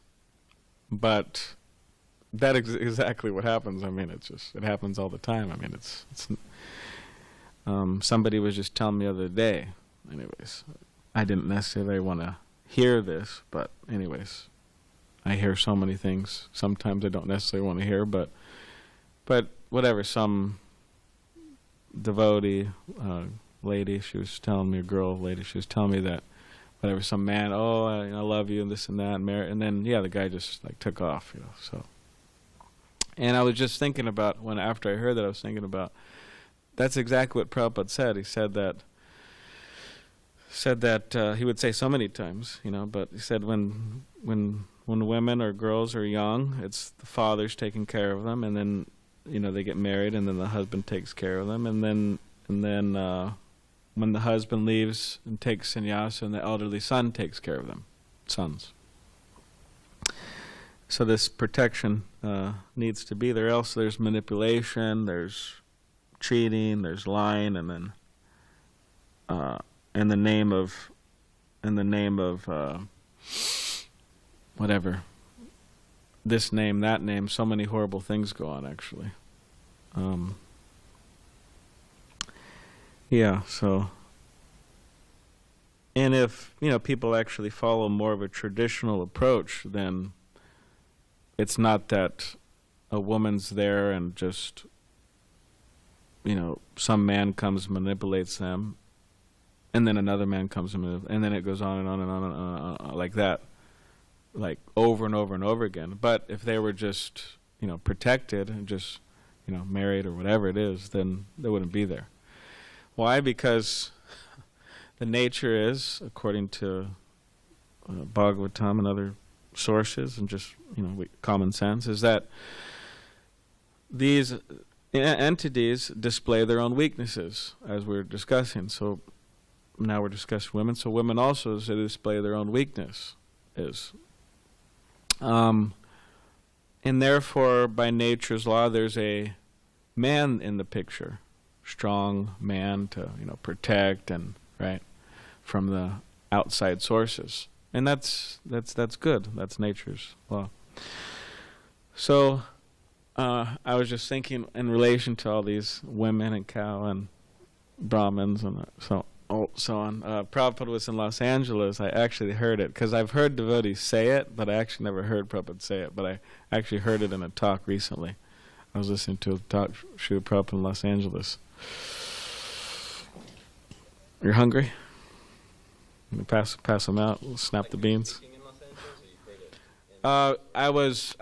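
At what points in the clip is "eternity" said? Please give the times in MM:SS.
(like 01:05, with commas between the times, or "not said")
not said.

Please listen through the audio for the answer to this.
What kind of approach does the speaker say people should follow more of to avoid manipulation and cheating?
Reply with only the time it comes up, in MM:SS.
01:28.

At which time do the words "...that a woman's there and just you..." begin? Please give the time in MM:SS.
01:31.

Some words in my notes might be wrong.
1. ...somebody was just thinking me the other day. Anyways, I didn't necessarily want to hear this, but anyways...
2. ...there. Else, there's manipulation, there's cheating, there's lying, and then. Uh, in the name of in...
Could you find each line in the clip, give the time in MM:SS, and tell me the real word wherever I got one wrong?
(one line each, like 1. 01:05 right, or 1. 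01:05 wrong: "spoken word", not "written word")
1. 00:08 wrong: "telling", not "thinking"
2. 01:03 right.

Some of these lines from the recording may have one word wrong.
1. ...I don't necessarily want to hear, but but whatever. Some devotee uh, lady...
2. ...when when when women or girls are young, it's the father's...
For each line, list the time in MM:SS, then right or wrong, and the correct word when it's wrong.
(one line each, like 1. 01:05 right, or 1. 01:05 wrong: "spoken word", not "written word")
1. 00:17 right
2. 00:43 right.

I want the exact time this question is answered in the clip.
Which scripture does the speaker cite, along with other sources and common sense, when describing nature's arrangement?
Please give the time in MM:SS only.
01:58.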